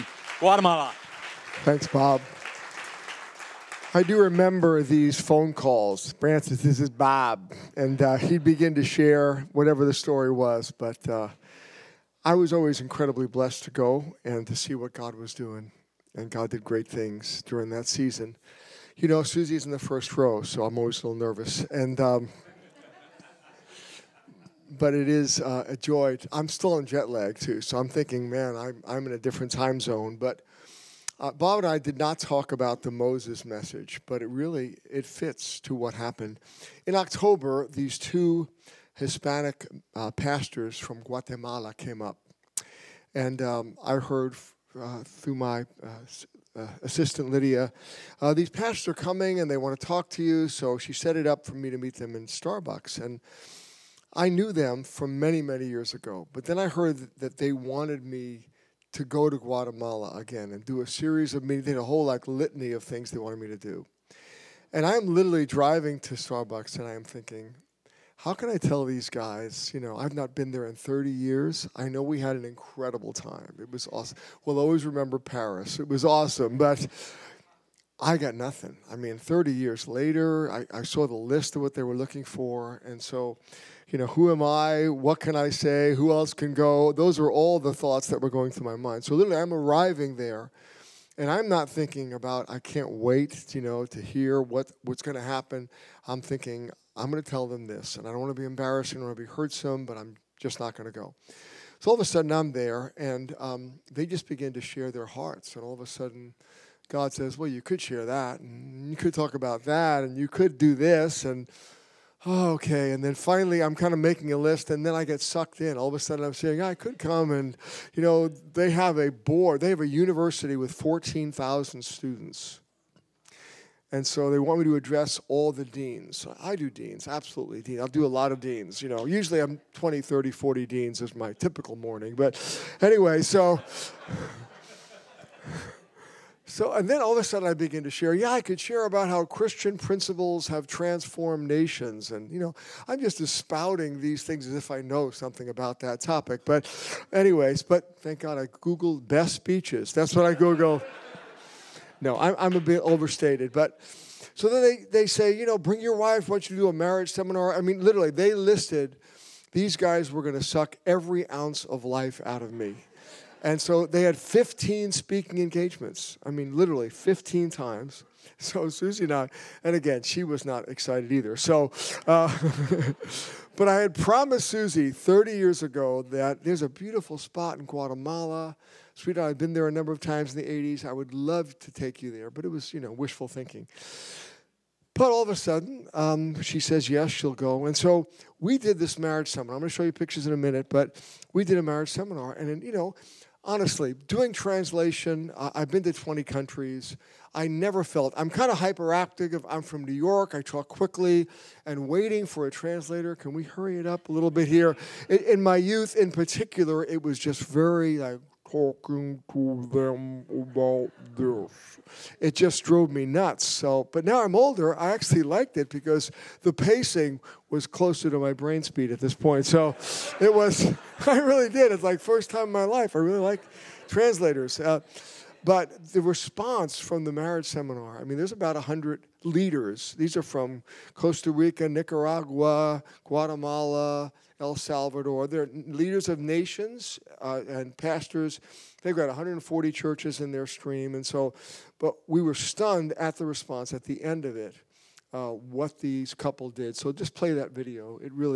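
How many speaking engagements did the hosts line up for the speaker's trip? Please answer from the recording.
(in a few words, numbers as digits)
15.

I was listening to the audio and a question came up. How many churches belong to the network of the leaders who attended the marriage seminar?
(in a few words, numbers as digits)
140.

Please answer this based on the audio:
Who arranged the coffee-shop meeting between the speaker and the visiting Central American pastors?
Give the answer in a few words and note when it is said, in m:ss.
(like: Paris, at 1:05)
Lydia, at 0:47.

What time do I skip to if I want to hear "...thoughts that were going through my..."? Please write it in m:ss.
1:27.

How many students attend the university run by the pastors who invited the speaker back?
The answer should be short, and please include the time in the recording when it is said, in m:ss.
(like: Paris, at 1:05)
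14,000, at 2:00.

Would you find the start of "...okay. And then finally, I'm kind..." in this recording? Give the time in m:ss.
1:52.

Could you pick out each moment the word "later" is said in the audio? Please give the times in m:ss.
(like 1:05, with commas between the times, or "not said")
1:19.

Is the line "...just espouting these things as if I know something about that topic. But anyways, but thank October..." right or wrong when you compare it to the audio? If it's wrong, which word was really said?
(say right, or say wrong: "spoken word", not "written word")
wrong: "God", not "October".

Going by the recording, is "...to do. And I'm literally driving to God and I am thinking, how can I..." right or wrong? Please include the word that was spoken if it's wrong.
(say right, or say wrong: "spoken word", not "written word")
wrong: "Starbucks", not "God".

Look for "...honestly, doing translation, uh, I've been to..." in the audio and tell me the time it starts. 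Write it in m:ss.
3:13.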